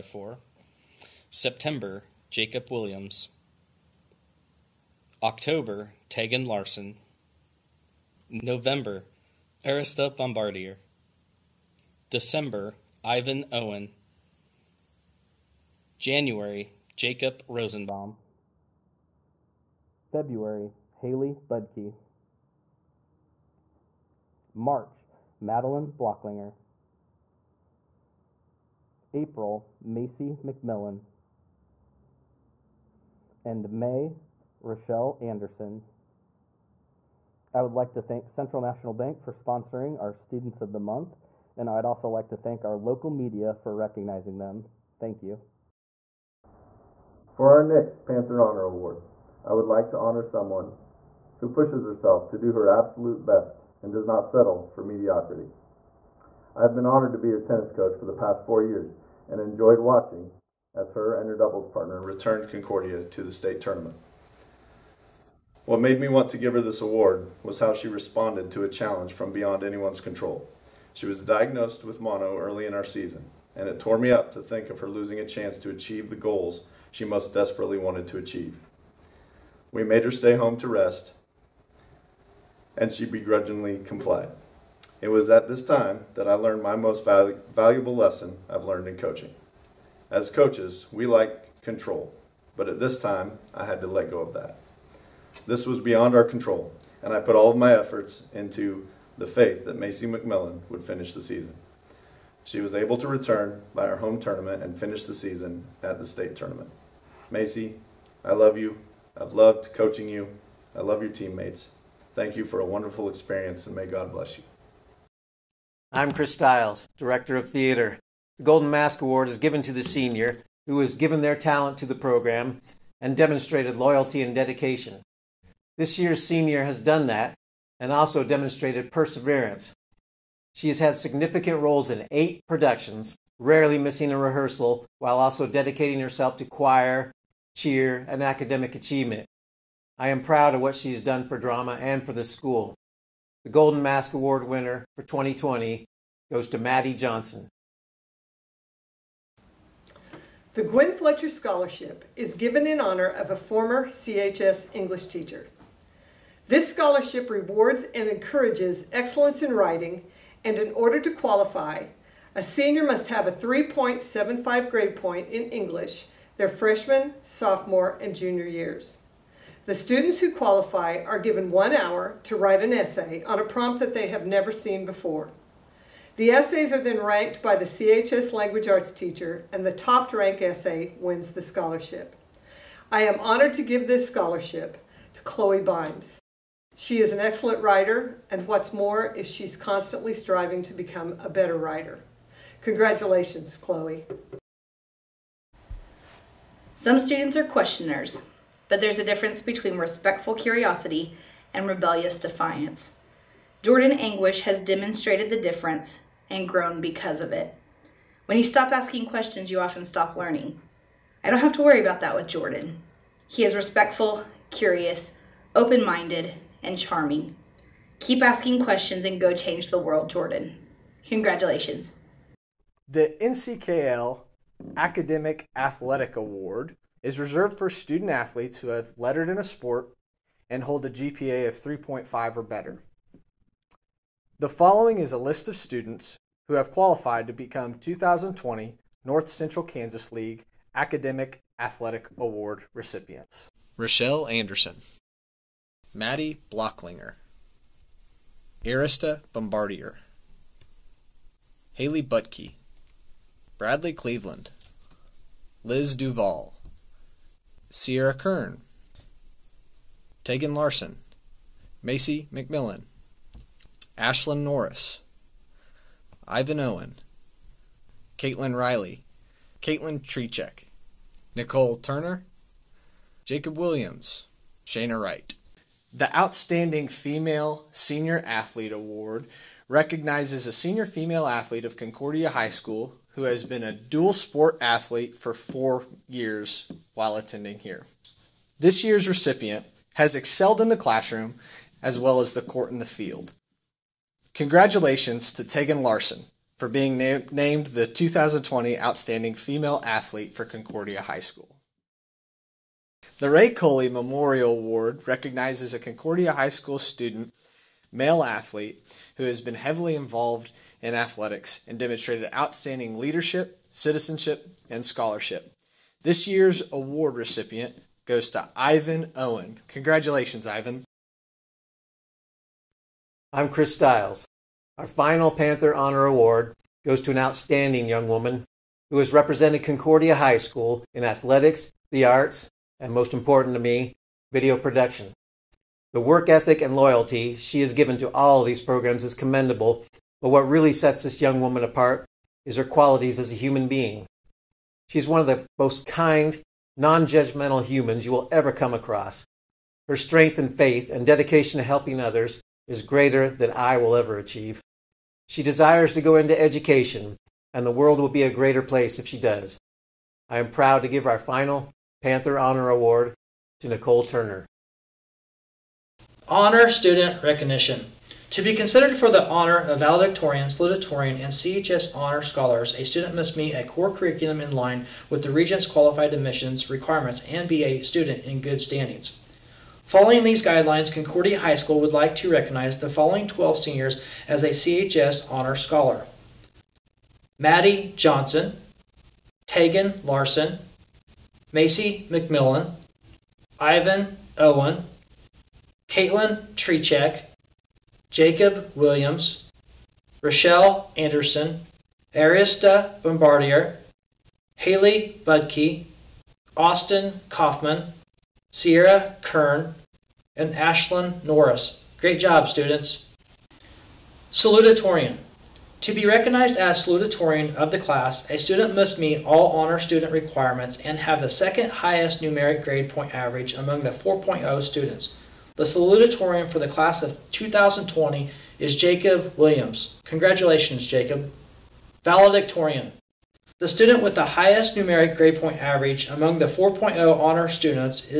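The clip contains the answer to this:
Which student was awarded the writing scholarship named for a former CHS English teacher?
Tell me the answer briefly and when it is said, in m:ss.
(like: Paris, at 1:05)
Chloe Bimes, at 3:05.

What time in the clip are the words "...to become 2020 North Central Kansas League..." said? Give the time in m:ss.
3:57.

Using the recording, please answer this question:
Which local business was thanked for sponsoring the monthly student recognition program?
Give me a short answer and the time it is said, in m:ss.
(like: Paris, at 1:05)
Central National Bank, at 0:38.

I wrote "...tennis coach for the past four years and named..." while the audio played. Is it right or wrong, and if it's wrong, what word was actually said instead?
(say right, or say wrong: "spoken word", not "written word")
wrong: "enjoyed", not "named".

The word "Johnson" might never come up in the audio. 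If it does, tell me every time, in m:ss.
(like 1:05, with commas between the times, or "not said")
2:26, 6:27.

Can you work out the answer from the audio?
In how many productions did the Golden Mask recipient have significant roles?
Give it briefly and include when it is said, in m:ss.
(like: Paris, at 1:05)
8, at 2:12.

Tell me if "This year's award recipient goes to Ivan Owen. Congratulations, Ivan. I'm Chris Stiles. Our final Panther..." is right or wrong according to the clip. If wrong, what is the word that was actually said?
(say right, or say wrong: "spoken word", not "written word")
right.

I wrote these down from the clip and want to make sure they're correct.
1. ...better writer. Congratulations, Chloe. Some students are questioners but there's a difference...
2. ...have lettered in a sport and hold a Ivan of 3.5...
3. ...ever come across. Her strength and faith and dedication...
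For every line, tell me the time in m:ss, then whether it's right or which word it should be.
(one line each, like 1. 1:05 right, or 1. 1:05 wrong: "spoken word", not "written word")
1. 3:11 right
2. 3:48 wrong: "GPA", not "Ivan"
3. 5:48 right.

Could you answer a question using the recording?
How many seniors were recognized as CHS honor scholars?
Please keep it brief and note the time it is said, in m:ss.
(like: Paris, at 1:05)
12, at 6:23.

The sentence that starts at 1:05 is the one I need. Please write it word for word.
What made me want to give her this award was how she responded to a challenge from beyond anyone's control.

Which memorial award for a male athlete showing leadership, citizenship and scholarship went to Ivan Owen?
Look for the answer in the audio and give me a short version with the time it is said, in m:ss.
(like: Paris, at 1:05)
Ray Coley Memorial Award, at 5:03.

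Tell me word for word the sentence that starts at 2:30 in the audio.
The Gwen Fletcher Scholarship is given in honor of a former CHS English teacher.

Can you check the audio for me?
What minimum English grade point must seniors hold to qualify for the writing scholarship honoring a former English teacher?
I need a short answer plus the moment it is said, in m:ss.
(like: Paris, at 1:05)
3.75, at 2:43.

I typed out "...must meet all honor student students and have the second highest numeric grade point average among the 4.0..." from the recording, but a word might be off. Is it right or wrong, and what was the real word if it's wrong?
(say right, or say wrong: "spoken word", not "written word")
wrong: "requirements", not "students".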